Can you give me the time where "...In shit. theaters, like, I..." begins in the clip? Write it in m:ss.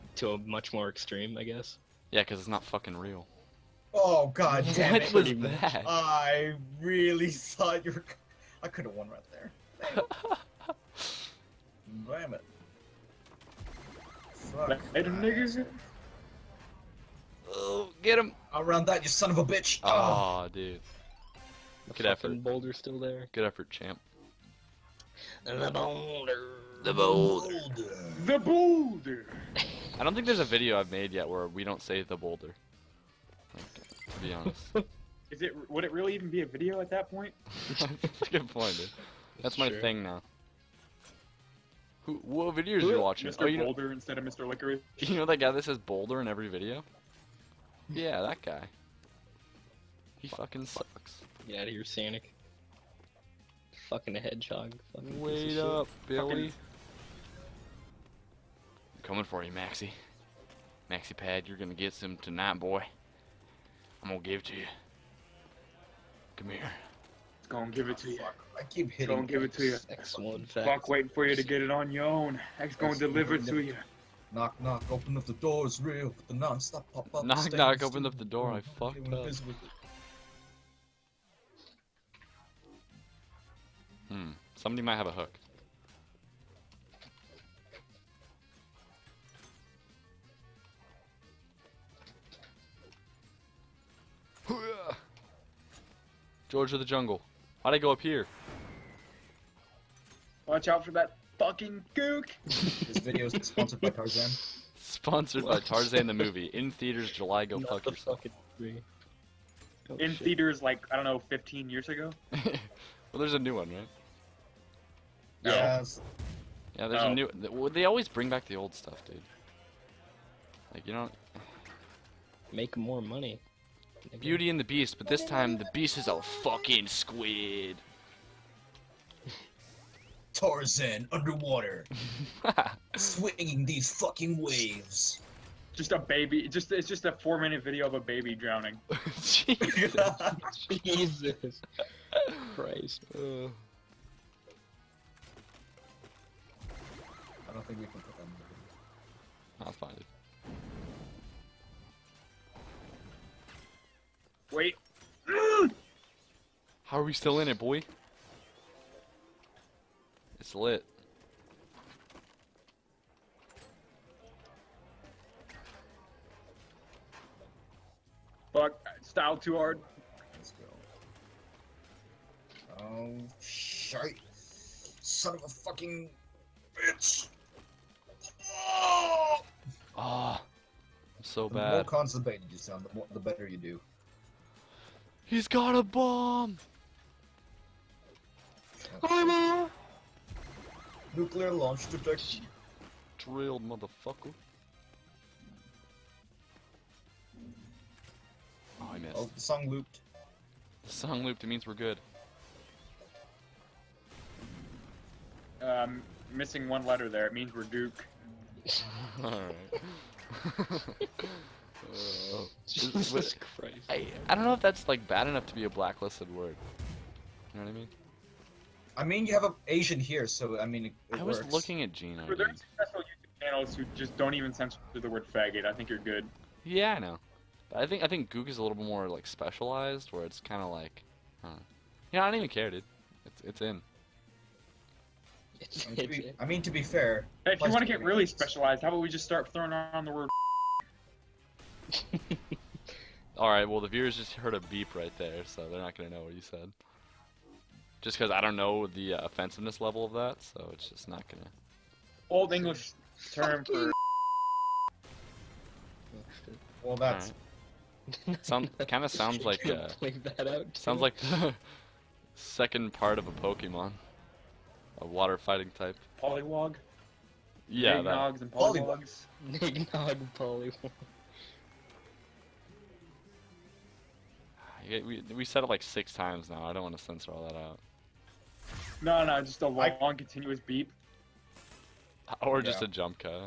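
1:49.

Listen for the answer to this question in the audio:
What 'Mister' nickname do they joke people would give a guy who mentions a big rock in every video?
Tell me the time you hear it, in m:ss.
0:44.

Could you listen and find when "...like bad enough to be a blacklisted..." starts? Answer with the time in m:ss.
3:34.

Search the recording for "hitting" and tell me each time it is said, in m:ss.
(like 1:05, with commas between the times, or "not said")
1:08.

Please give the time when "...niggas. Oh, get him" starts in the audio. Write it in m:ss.
0:14.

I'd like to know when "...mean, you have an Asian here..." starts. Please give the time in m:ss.
3:39.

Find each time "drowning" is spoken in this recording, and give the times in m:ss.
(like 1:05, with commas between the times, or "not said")
2:18.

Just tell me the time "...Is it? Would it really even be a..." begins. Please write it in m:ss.
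0:35.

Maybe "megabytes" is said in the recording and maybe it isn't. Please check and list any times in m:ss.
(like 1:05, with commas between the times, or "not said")
not said.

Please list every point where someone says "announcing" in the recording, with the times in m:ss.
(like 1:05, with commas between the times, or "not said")
not said.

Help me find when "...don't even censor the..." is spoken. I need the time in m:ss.
3:44.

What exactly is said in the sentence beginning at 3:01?
The more constipated you sound, the, more, the better you do.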